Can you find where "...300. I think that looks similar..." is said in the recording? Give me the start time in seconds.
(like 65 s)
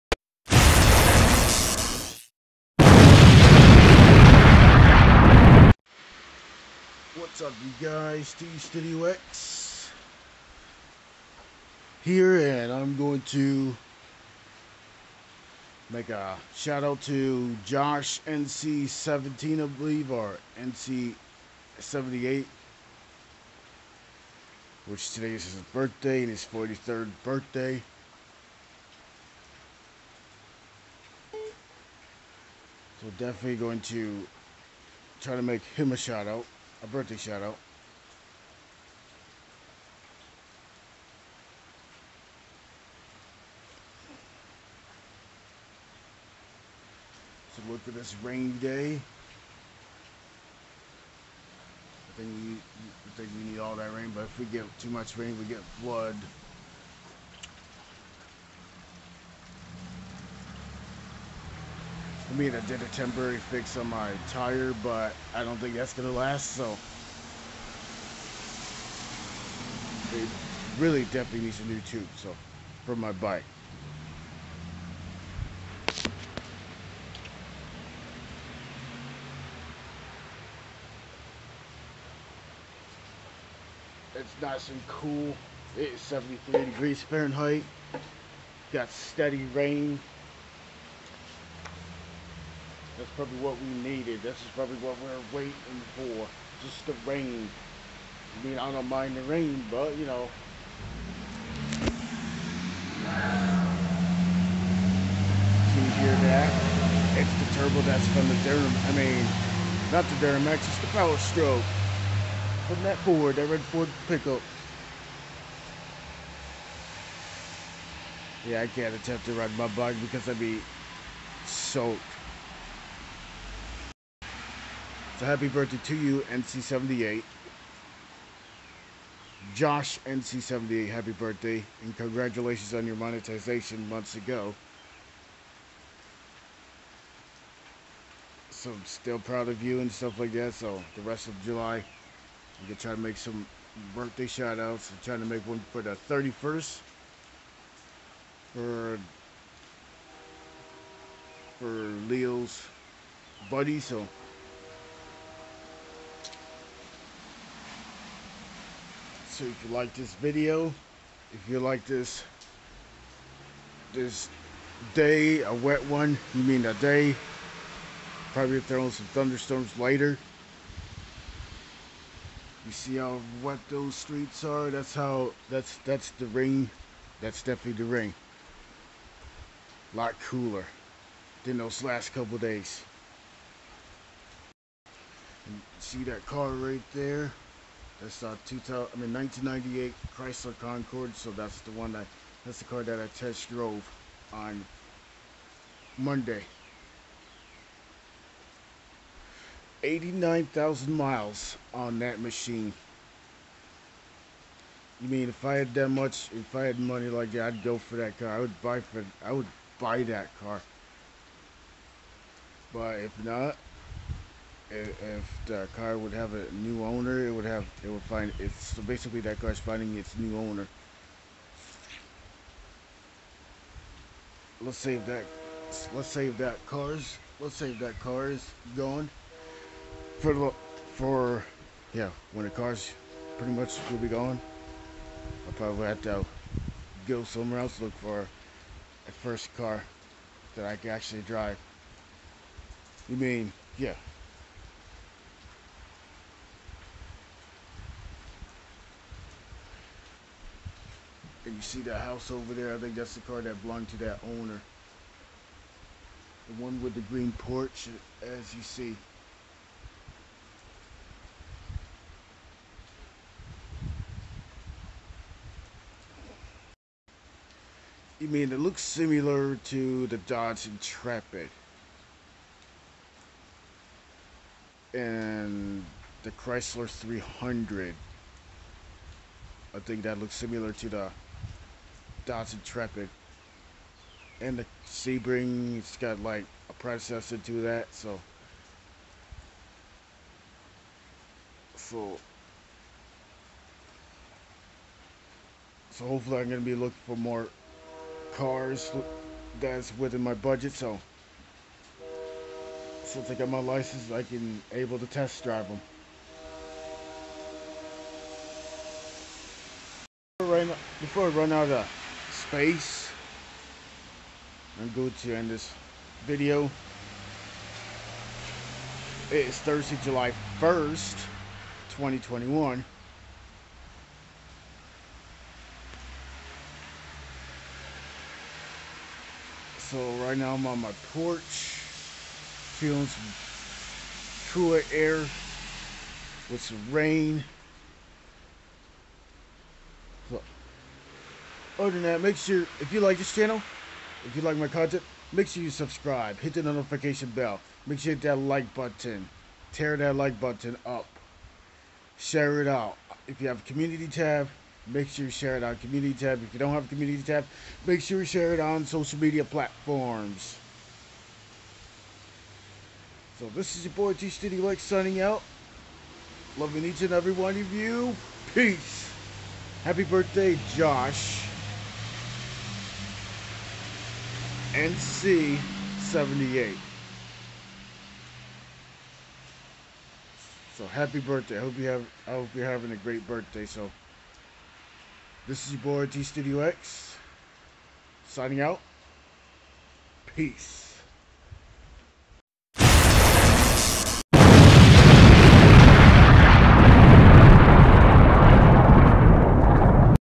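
276 s.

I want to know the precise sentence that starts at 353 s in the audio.
If you have a community tab, make sure you share it on community tab.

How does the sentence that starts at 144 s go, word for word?
I'm trying to make one for the 31st.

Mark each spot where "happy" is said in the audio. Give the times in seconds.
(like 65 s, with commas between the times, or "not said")
125 s, 130 s, 369 s, 380 s.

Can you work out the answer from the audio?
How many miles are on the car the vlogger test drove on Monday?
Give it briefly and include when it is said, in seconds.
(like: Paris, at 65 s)
89,000, at 199 s.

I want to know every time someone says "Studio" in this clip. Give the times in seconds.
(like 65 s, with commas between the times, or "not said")
364 s, 386 s.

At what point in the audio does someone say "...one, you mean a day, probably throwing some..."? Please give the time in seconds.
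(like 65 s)
165 s.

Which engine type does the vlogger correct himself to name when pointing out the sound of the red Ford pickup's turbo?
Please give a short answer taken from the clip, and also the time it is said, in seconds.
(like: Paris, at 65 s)
Power Stroke, at 110 s.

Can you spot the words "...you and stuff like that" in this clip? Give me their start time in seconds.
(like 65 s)
139 s.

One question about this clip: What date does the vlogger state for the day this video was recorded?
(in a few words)
July 1st, 2021.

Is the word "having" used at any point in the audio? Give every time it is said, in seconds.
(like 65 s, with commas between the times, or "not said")
382 s.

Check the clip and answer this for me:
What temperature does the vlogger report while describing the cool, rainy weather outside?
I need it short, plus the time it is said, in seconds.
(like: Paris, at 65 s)
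73 degrees Fahrenheit, at 86 s.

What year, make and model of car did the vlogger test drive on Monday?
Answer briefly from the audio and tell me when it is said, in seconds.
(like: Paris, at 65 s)
1998 Chrysler Concorde, at 189 s.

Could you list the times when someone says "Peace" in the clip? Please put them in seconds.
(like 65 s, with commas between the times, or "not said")
368 s, 390 s.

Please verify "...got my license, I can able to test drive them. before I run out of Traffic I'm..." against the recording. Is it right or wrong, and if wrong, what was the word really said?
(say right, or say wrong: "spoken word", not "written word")
wrong: "Face", not "Traffic".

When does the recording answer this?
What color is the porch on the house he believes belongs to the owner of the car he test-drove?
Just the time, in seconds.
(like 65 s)
257 s.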